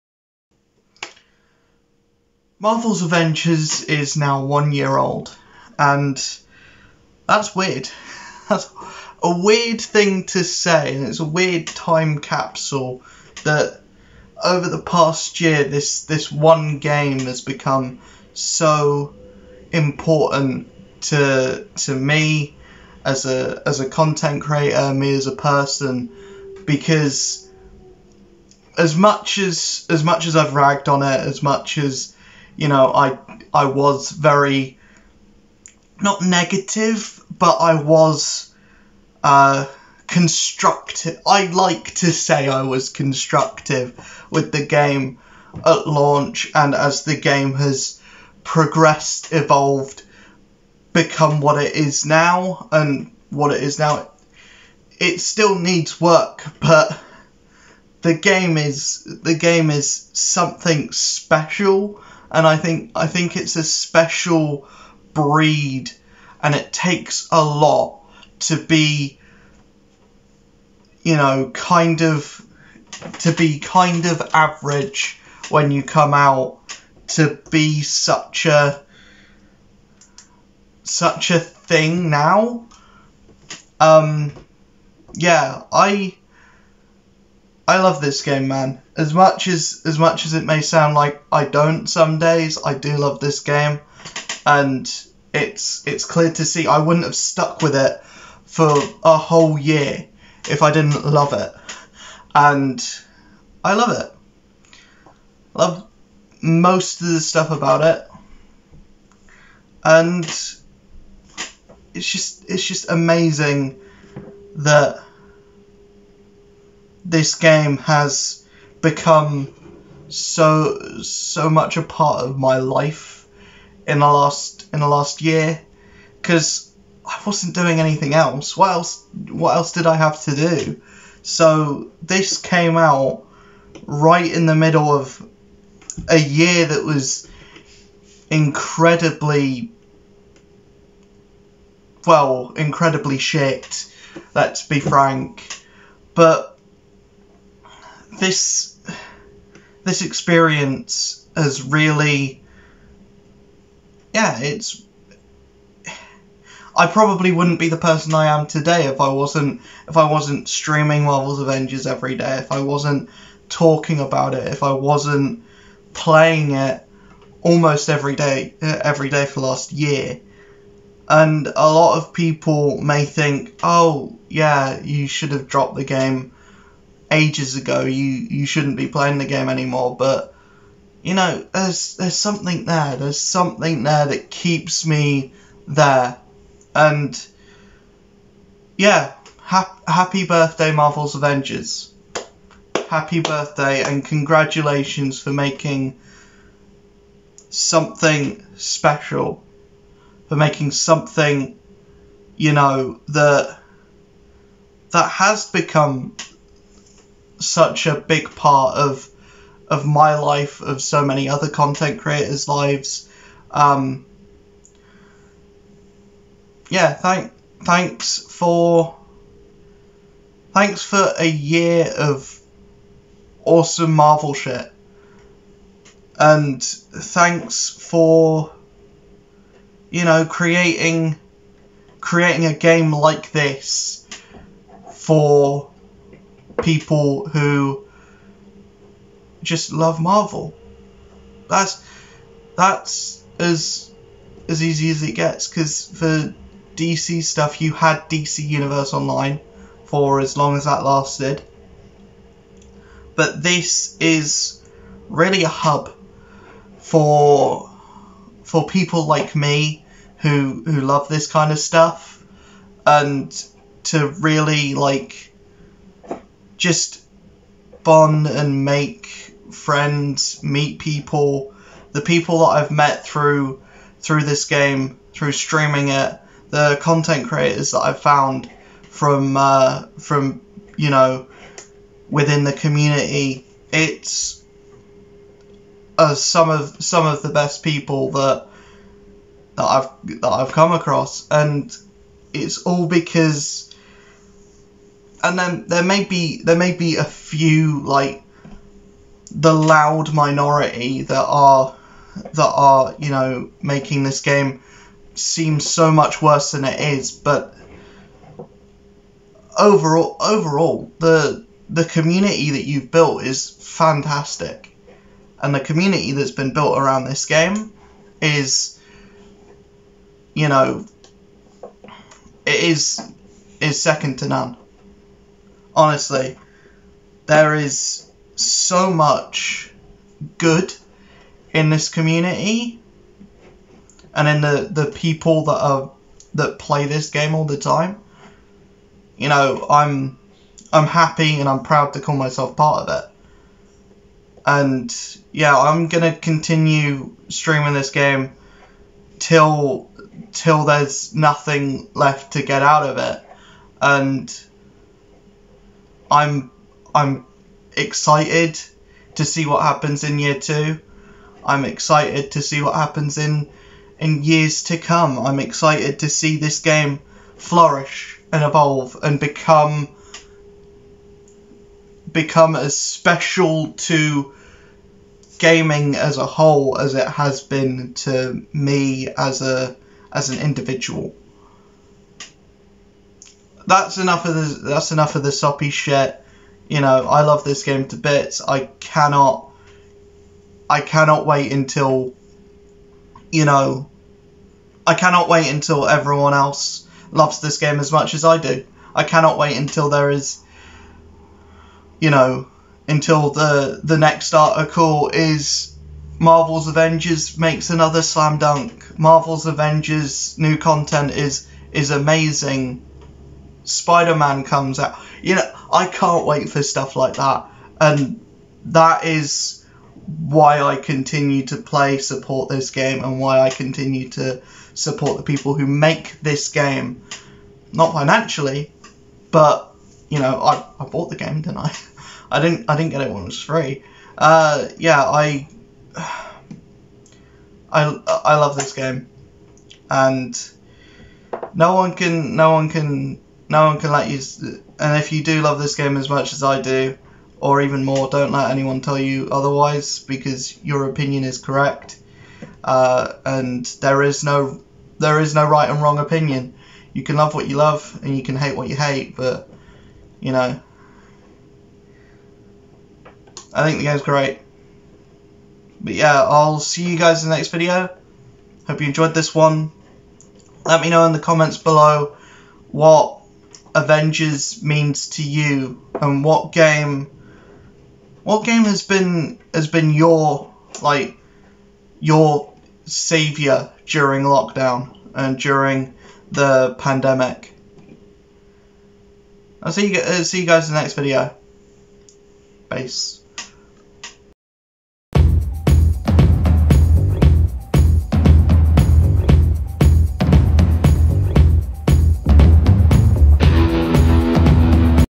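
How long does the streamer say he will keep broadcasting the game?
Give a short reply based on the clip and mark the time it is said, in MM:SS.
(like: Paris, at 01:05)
Till there's nothing left, at 05:50.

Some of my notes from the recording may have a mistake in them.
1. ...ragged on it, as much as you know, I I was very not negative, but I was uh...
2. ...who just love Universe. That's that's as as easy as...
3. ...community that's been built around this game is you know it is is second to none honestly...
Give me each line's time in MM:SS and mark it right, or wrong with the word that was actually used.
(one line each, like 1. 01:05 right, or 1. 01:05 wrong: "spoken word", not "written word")
1. 00:30 right
2. 03:57 wrong: "Marvel", not "Universe"
3. 05:15 right.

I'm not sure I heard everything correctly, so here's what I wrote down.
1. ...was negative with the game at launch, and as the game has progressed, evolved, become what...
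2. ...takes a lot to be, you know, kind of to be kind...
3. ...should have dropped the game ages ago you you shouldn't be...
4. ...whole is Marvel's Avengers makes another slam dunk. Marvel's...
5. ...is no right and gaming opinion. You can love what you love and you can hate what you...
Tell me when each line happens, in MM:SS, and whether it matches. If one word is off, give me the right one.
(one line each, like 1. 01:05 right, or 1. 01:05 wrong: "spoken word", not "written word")
1. 00:42 wrong: "constructive", not "negative"
2. 01:06 right
3. 02:55 right
4. 06:44 wrong: "article", not "whole"
5. 07:35 wrong: "wrong", not "gaming".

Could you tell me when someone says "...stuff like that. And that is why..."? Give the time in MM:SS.
06:56.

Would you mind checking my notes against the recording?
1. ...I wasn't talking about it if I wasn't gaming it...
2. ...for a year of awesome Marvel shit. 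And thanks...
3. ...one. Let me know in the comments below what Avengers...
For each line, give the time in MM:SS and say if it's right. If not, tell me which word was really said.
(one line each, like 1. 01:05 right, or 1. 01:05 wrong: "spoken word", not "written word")
1. 02:42 wrong: "playing", not "gaming"
2. 03:40 right
3. 07:49 right.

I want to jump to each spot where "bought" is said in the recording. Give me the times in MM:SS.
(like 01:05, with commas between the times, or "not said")
07:10.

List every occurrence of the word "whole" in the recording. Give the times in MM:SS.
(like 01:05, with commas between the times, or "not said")
01:39, 06:16.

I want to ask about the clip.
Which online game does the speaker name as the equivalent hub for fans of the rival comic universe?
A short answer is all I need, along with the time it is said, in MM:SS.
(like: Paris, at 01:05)
DC Universe Online, at 04:08.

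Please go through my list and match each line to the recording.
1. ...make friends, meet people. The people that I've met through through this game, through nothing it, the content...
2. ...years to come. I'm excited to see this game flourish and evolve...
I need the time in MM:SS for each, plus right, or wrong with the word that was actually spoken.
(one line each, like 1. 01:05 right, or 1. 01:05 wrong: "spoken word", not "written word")
1. 04:28 wrong: "streaming", not "nothing"
2. 06:04 right.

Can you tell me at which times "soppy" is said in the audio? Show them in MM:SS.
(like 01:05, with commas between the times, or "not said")
06:25.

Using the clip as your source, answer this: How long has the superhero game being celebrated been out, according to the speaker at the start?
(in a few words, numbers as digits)
One year.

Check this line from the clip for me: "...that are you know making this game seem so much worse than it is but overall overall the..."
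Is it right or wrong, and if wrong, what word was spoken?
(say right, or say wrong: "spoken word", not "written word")
right.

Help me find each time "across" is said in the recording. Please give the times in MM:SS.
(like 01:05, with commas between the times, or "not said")
04:50.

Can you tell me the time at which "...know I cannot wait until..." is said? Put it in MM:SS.
06:33.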